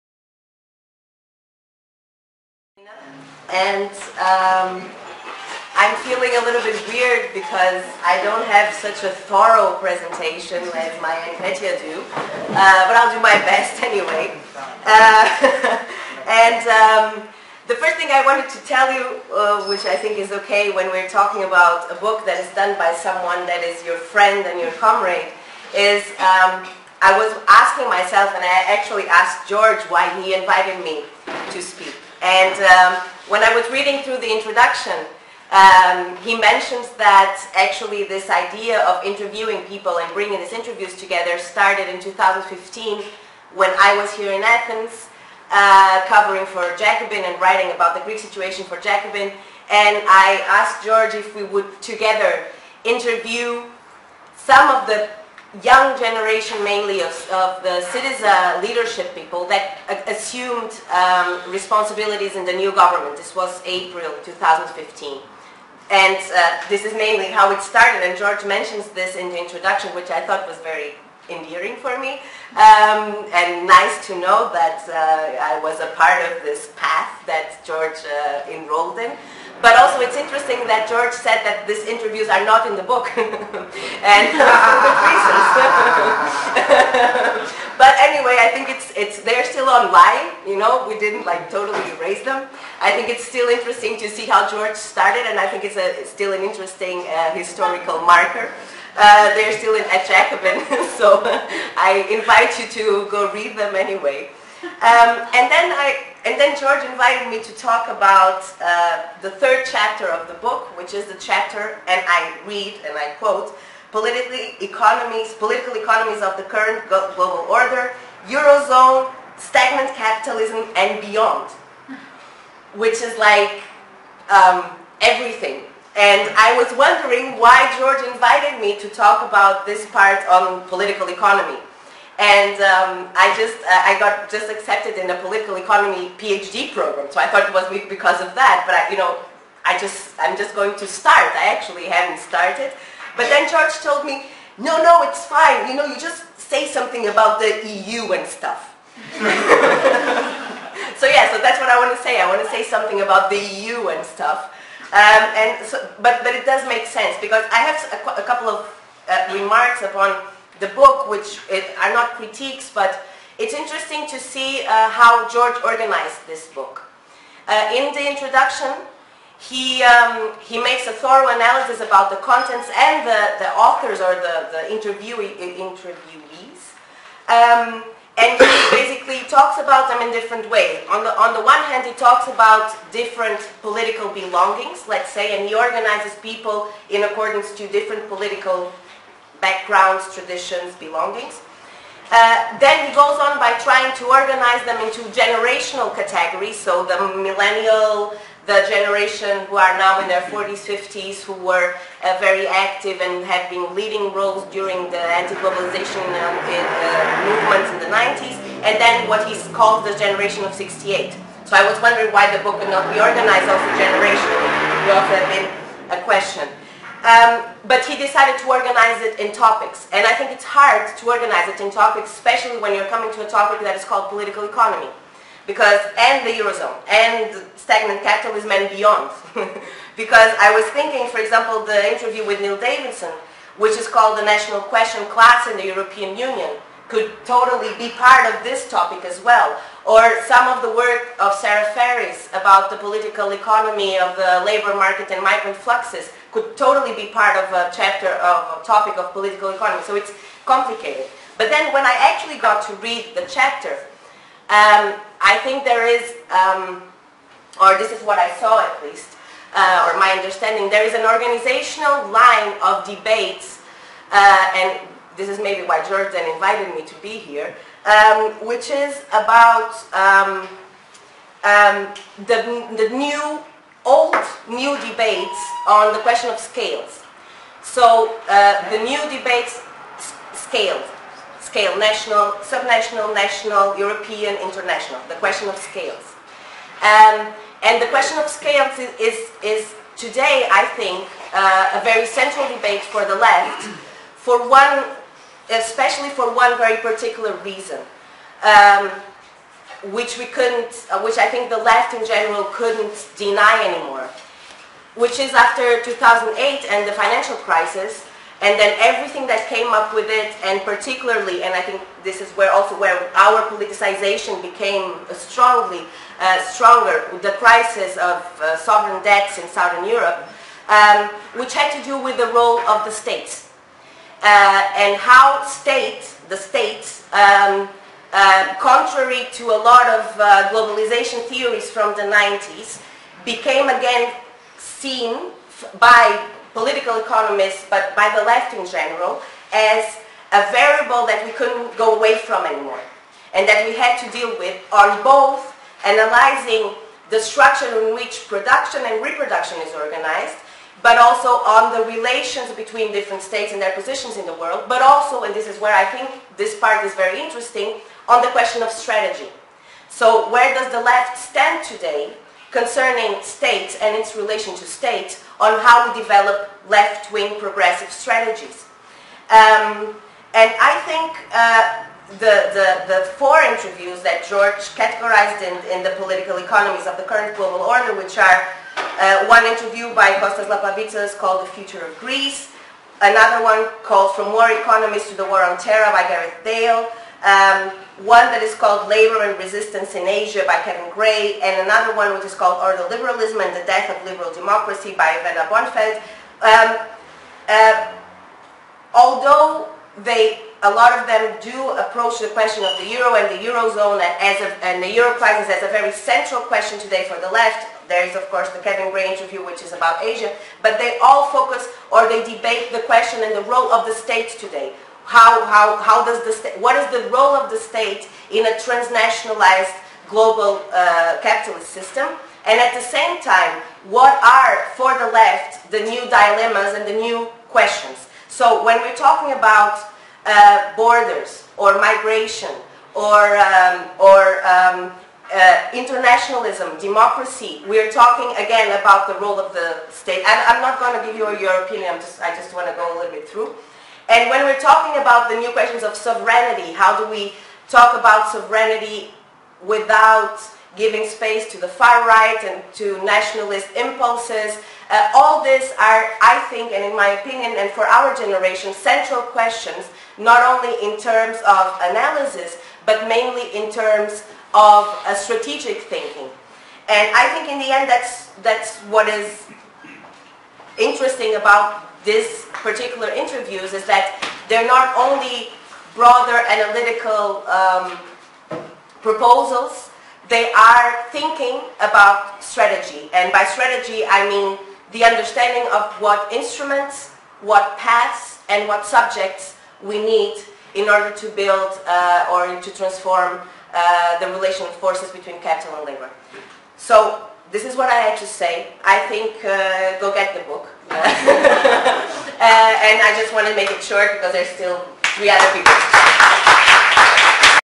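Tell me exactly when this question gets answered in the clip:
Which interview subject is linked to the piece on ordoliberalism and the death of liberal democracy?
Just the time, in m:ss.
6:35.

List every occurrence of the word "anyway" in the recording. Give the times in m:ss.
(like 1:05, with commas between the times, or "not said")
0:13, 1:28, 1:43.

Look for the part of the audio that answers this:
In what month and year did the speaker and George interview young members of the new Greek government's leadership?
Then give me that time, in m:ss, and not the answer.
1:03.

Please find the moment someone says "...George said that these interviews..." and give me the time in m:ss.
1:20.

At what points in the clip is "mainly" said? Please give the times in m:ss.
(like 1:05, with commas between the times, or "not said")
0:56, 1:06, 7:43.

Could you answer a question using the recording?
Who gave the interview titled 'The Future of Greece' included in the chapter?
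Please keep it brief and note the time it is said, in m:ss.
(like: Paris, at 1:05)
Kostas Lapavitsas, at 6:20.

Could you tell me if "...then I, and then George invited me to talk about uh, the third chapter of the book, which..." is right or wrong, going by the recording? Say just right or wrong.
right.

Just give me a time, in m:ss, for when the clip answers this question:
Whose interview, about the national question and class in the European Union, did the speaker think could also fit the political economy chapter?
3:52.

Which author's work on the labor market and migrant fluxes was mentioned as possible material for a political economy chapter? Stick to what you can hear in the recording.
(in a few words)
Sara Farris.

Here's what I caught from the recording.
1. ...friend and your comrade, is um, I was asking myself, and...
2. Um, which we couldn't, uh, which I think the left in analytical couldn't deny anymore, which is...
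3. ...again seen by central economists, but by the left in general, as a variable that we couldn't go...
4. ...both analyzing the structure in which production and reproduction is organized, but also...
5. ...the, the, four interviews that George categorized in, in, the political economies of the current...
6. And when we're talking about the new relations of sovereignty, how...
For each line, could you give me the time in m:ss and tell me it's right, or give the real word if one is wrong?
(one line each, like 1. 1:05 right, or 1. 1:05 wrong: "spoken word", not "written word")
1. 0:23 right
2. 4:58 wrong: "general", not "analytical"
3. 5:33 wrong: "political", not "central"
4. 5:45 right
5. 6:12 right
6. 7:24 wrong: "questions", not "relations".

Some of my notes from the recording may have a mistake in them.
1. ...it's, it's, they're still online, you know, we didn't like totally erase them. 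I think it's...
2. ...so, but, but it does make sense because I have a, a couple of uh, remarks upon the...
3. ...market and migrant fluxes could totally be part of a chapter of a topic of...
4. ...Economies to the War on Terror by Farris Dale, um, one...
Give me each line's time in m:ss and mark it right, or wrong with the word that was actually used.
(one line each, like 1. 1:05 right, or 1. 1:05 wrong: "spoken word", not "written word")
1. 1:28 right
2. 2:35 right
3. 4:04 right
4. 6:24 wrong: "Gareth", not "Farris".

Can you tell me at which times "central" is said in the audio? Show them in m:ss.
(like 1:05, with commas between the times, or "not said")
4:52, 6:45, 7:38.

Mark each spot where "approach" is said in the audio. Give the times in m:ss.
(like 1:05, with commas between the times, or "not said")
6:41.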